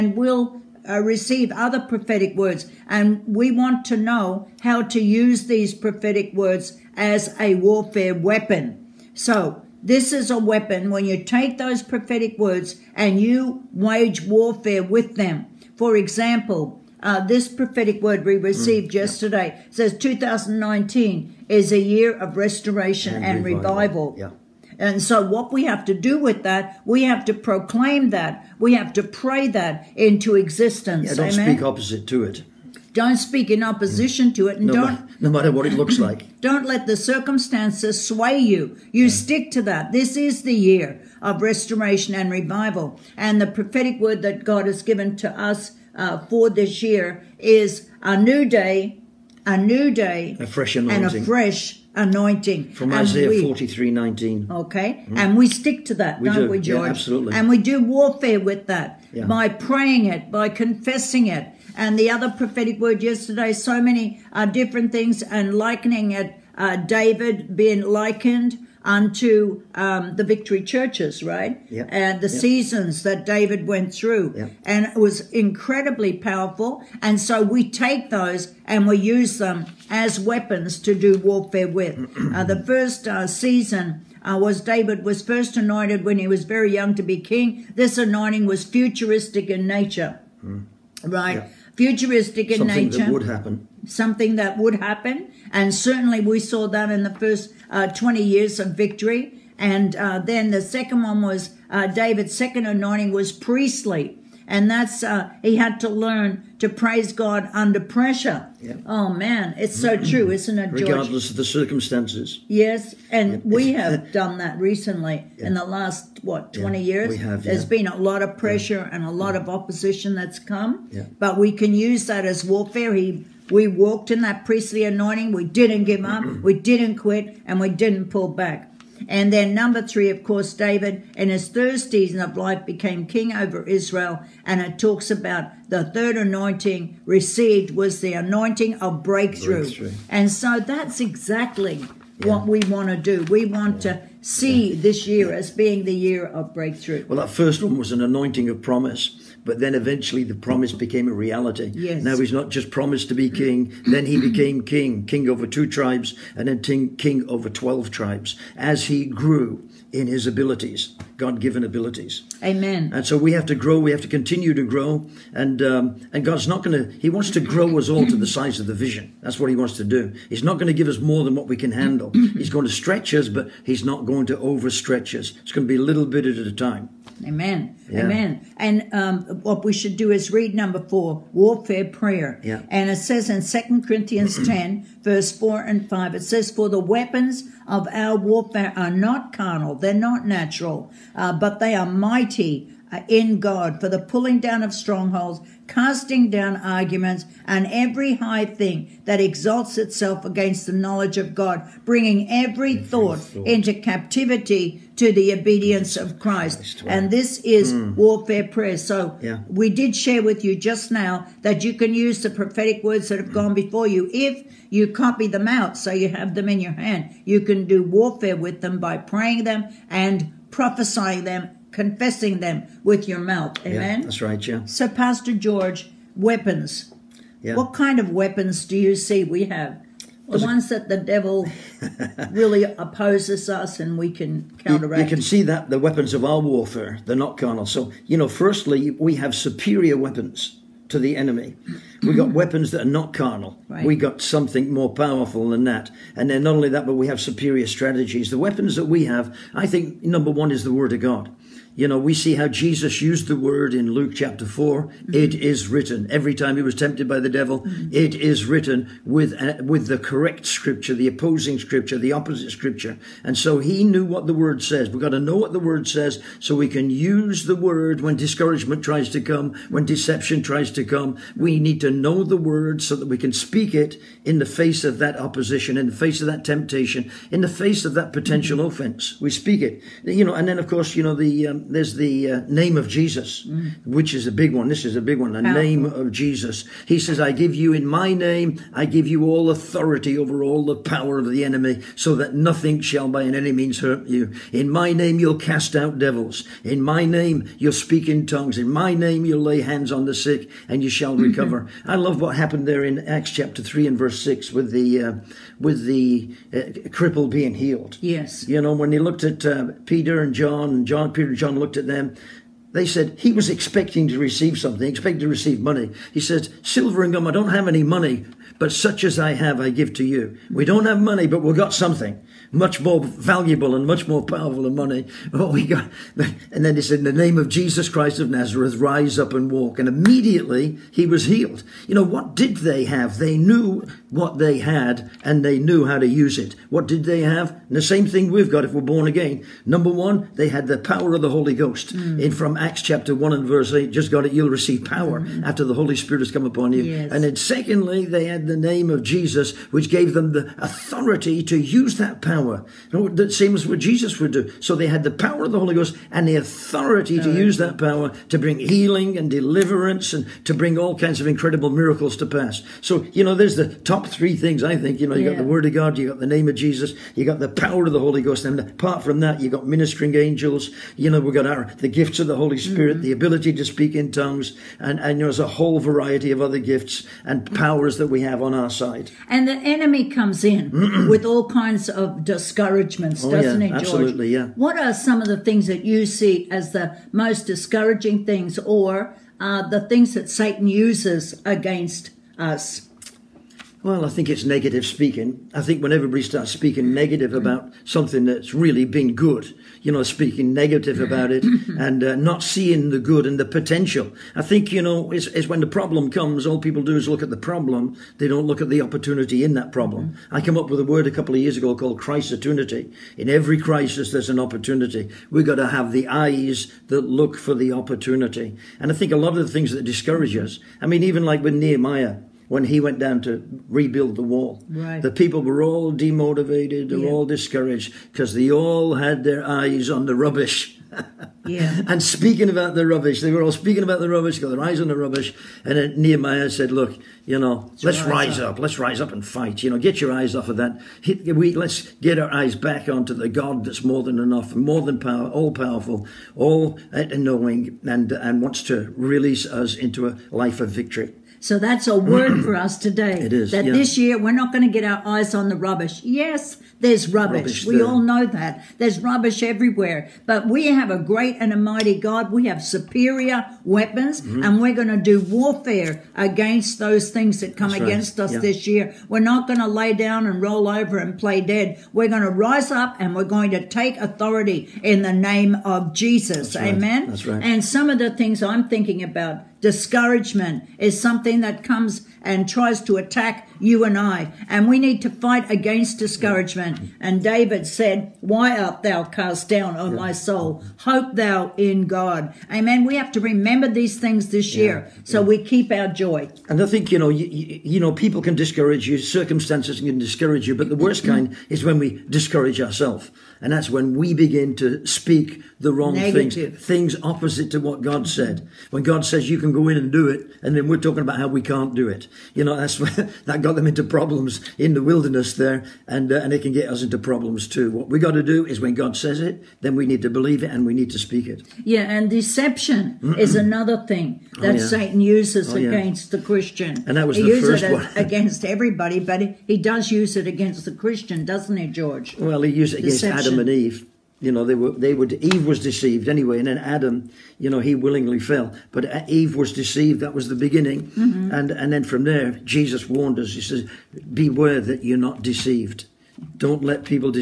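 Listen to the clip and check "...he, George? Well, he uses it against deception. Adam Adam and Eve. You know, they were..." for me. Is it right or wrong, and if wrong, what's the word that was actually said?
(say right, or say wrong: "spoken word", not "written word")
right.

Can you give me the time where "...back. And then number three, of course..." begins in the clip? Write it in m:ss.
2:08.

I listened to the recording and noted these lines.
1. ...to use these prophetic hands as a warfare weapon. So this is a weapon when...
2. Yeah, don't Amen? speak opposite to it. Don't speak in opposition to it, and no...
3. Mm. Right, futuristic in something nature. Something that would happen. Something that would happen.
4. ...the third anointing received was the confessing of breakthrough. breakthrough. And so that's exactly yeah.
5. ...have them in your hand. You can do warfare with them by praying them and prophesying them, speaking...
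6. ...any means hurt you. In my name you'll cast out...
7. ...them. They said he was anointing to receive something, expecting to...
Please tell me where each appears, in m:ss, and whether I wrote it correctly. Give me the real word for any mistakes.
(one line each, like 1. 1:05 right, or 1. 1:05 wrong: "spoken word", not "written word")
1. 0:04 wrong: "words", not "hands"
2. 0:31 right
3. 1:30 right
4. 2:15 wrong: "anointing", not "confessing"
5. 3:36 wrong: "confessing", not "speaking"
6. 4:53 right
7. 5:11 wrong: "expecting", not "anointing".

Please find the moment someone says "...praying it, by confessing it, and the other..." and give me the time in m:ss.
0:59.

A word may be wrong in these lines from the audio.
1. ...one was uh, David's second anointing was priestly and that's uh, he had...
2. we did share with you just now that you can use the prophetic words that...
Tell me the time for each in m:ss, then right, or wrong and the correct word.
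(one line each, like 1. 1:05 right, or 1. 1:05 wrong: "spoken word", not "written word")
1. 1:41 right
2. 3:29 right.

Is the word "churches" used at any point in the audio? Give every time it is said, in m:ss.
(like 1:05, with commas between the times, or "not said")
1:10.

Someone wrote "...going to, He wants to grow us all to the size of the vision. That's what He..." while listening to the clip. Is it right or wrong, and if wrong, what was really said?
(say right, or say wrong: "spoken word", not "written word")
right.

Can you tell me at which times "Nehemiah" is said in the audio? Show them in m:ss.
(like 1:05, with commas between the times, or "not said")
7:01, 7:15.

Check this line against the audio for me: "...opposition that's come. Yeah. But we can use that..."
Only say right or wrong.
right.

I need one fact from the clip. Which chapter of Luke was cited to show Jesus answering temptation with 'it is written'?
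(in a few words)
Chapter 4.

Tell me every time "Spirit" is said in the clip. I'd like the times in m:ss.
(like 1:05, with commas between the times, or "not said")
5:45, 6:12.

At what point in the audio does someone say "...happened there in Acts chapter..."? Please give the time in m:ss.
5:02.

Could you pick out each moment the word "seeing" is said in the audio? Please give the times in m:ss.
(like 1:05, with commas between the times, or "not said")
6:42.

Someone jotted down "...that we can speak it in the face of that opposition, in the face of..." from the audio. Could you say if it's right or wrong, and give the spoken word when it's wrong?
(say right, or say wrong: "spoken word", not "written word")
right.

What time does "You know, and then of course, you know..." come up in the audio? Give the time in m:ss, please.
4:40.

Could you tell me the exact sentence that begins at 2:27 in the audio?
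Well, that first one was an anointing of promise but then eventually the promise became a reality.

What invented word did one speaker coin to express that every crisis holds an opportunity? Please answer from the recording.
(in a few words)
Crisistunity.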